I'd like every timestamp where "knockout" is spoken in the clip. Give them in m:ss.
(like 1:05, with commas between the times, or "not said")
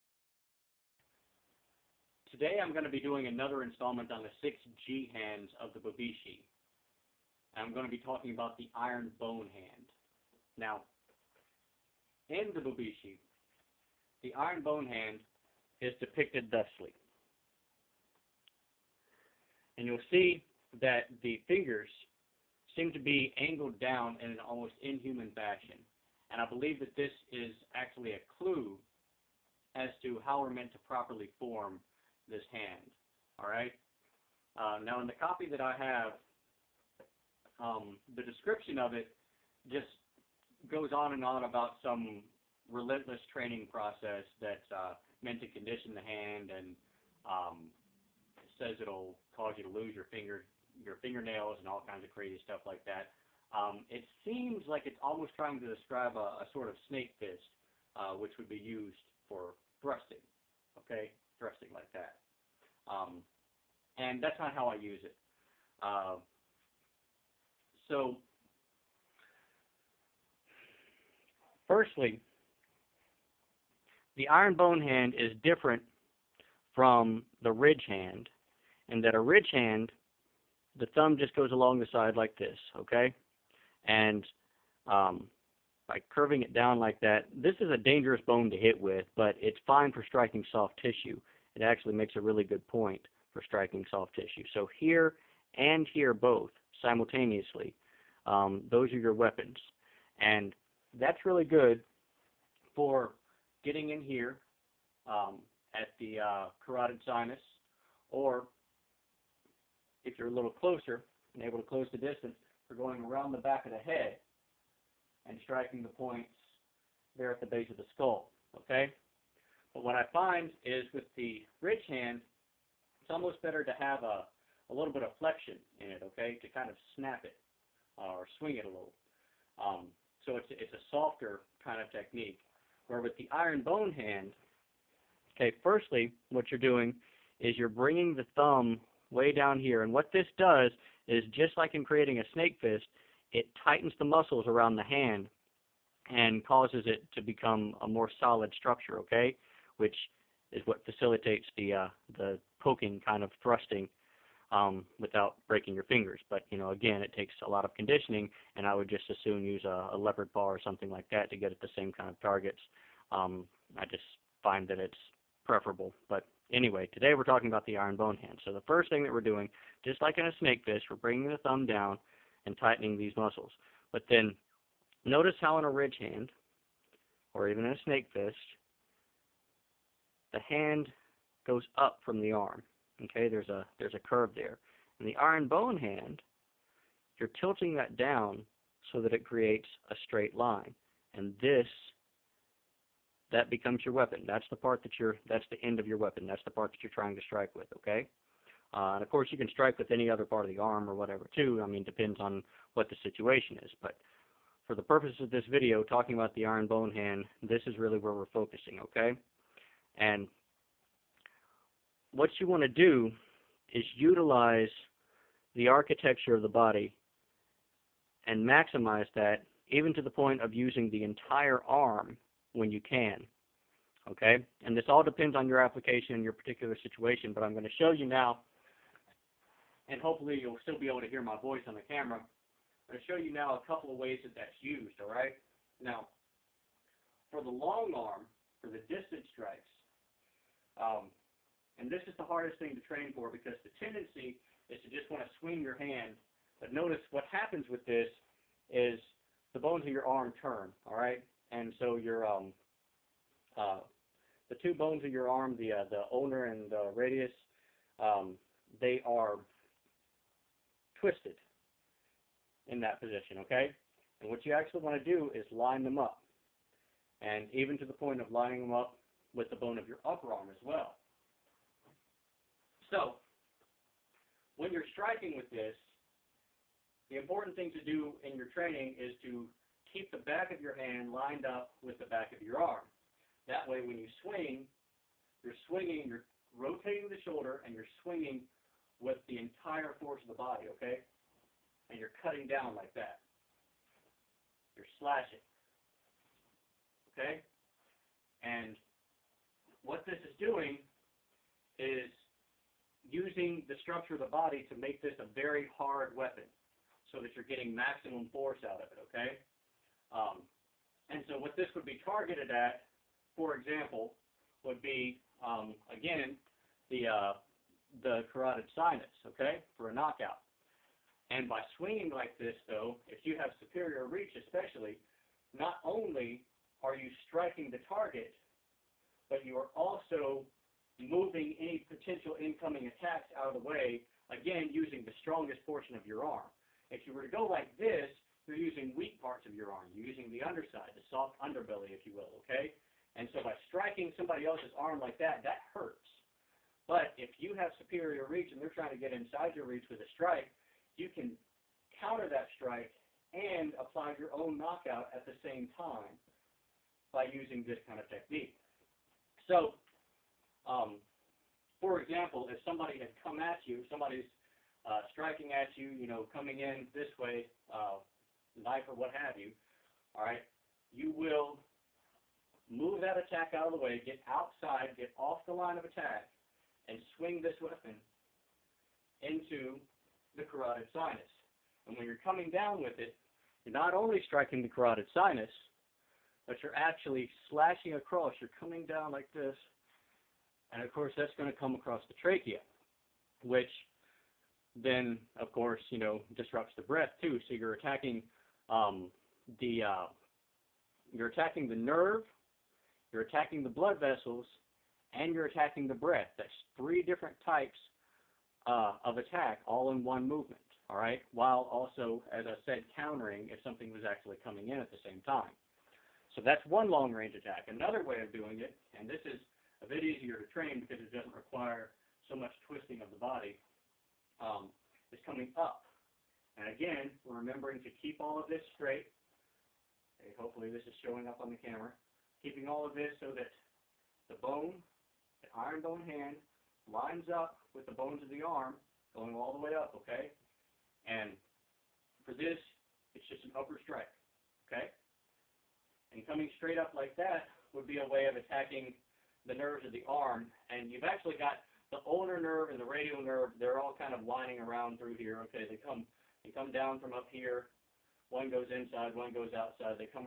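5:19, 5:54.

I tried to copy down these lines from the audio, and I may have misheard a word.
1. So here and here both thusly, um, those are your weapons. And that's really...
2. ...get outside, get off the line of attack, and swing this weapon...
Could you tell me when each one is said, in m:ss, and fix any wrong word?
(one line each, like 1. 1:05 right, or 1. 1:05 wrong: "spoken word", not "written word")
1. 1:34 wrong: "simultaneously", not "thusly"
2. 6:14 right.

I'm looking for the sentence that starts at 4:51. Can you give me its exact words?
And you're cutting down like that.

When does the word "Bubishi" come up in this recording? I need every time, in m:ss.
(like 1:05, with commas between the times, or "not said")
0:05, 0:12.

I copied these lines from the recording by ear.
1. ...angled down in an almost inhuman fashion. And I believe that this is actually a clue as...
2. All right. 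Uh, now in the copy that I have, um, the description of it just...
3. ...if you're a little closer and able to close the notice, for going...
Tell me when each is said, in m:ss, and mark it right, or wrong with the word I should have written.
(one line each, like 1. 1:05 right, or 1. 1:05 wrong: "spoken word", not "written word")
1. 0:23 right
2. 0:33 right
3. 1:50 wrong: "distance", not "notice".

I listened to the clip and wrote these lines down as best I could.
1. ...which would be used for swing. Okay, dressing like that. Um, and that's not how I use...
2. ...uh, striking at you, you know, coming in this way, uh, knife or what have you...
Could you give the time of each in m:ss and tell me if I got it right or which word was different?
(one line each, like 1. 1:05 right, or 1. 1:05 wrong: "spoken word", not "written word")
1. 0:58 wrong: "thrusting", not "swing"
2. 6:04 right.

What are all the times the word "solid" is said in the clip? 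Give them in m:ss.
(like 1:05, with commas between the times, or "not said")
2:28.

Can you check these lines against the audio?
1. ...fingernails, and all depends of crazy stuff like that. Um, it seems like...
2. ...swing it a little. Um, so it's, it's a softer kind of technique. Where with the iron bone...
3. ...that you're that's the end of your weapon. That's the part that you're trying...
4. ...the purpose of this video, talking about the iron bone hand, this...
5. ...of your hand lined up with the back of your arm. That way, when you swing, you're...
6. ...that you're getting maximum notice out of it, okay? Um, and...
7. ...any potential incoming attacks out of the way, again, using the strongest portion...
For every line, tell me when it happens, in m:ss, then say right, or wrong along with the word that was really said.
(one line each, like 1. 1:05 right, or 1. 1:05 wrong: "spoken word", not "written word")
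1. 0:51 wrong: "kinds", not "depends"
2. 2:08 right
3. 3:14 right
4. 3:24 right
5. 4:40 right
6. 5:07 wrong: "force", not "notice"
7. 5:31 right.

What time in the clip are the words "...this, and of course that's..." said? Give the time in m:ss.
6:29.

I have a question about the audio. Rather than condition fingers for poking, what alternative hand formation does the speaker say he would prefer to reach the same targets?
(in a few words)
leopard bar.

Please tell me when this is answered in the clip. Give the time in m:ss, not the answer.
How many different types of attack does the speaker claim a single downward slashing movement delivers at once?
6:46.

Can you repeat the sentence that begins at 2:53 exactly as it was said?
But then notice how in a ridge hand, or even in a snake fist, the hand goes up from the arm.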